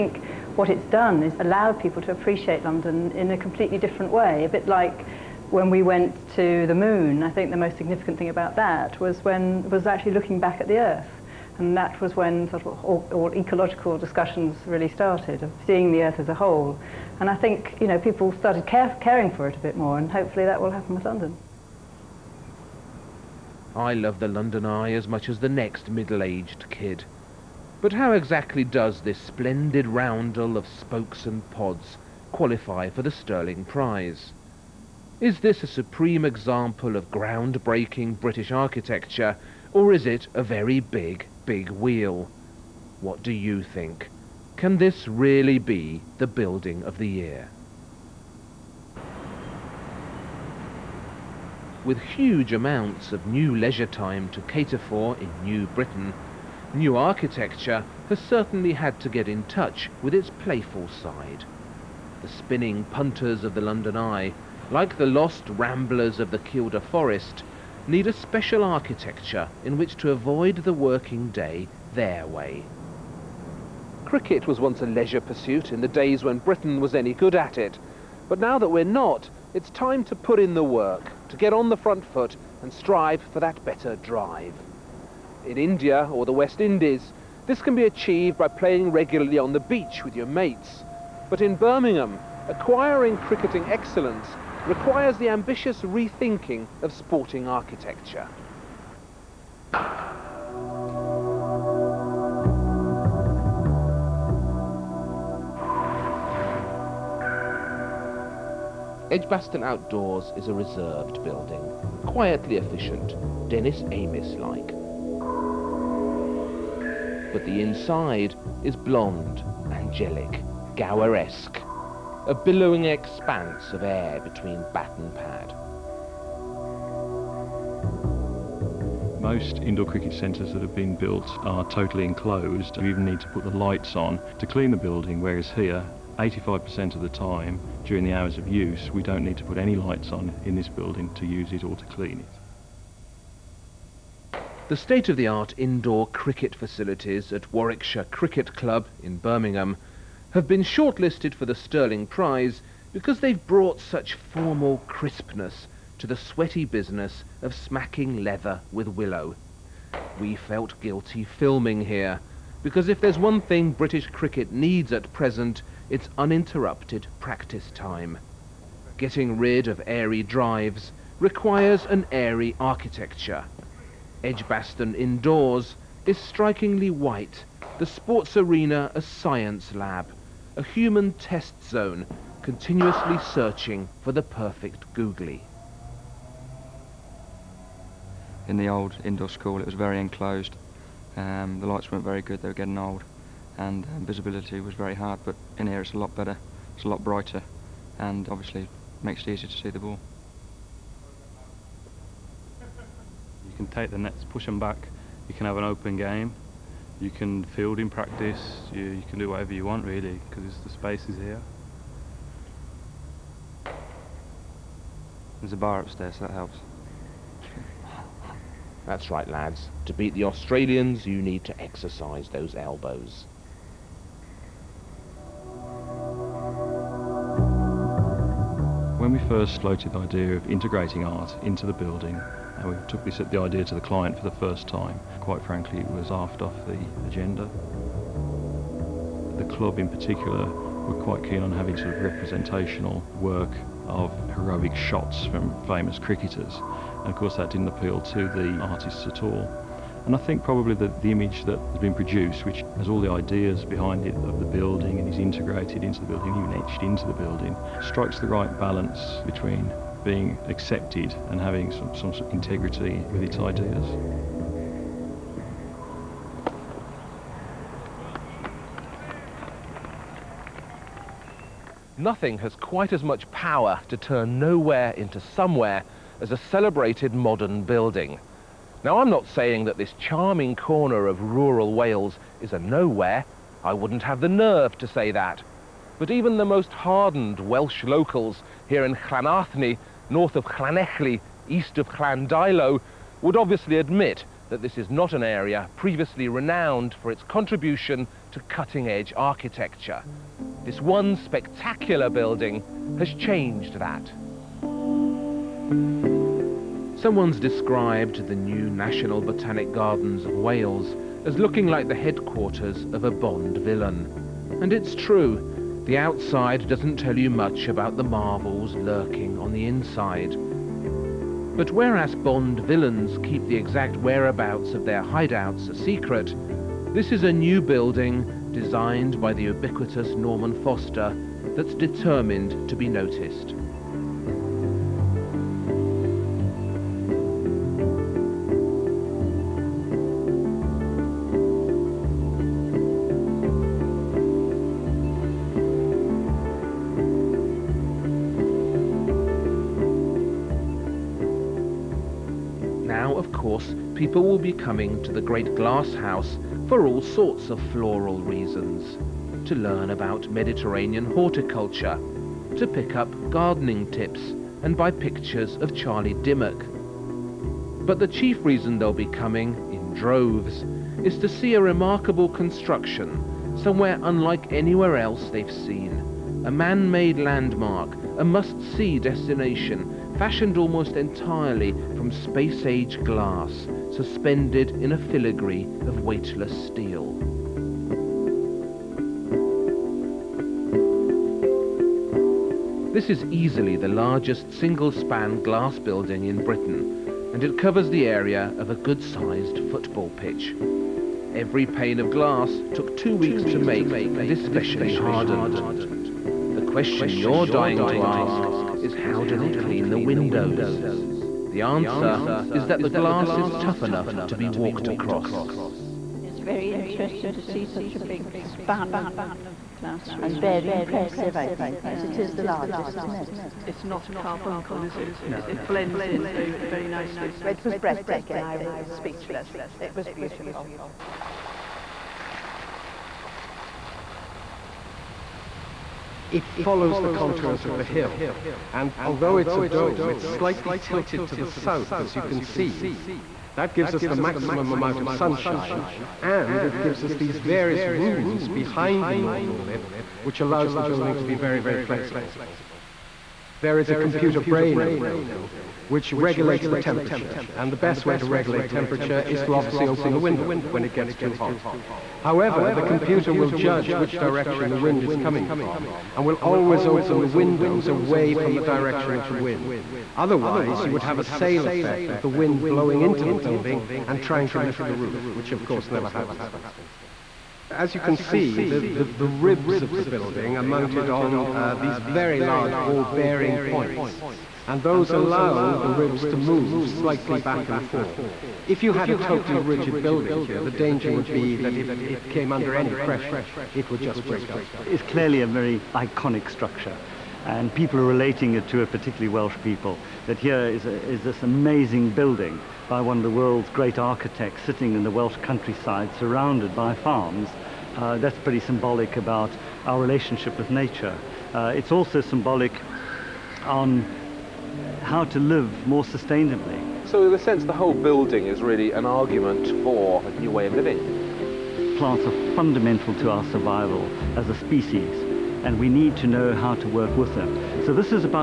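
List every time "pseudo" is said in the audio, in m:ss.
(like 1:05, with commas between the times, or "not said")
not said.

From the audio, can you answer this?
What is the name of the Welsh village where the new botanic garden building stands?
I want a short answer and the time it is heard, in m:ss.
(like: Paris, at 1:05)
Llanarthny, at 4:48.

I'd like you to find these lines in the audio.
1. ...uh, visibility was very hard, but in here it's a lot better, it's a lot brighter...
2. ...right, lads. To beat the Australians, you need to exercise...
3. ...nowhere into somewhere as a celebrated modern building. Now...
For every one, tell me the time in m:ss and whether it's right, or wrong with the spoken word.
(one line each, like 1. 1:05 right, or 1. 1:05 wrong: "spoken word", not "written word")
1. 3:13 right
2. 3:39 right
3. 4:34 right.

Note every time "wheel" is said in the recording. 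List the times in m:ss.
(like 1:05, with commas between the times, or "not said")
0:41.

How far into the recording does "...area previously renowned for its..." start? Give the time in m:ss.
4:55.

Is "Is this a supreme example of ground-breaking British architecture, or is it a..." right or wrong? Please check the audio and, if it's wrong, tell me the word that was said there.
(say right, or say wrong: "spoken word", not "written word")
right.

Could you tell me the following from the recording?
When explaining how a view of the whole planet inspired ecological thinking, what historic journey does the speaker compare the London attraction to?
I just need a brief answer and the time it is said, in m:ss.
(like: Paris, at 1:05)
the moon, at 0:06.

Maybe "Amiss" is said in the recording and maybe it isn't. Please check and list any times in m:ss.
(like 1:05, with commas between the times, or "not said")
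1:53.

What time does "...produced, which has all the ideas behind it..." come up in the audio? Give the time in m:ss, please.
4:11.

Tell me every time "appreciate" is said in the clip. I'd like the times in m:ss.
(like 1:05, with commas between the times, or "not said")
0:02.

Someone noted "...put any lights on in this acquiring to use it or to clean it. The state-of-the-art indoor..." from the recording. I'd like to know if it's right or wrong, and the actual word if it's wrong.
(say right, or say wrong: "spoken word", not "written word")
wrong: "building", not "acquiring".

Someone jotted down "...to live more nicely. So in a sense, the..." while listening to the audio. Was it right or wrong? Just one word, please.
wrong.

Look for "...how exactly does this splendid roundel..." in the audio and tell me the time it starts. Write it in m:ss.
0:27.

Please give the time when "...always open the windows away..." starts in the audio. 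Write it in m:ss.
7:46.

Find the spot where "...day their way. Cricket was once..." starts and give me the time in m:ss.
1:11.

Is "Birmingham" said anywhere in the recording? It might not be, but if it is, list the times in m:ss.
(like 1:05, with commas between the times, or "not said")
1:31, 2:29.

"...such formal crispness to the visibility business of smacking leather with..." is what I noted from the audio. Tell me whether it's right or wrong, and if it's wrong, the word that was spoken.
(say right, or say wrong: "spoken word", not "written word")
wrong: "sweaty", not "visibility".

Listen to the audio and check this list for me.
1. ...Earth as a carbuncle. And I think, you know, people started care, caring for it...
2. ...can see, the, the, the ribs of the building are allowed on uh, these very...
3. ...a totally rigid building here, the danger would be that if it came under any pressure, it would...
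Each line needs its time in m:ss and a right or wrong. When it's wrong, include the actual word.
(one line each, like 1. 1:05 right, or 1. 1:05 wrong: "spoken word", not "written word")
1. 0:16 wrong: "whole", not "carbuncle"
2. 7:57 wrong: "mounted", not "allowed"
3. 8:09 right.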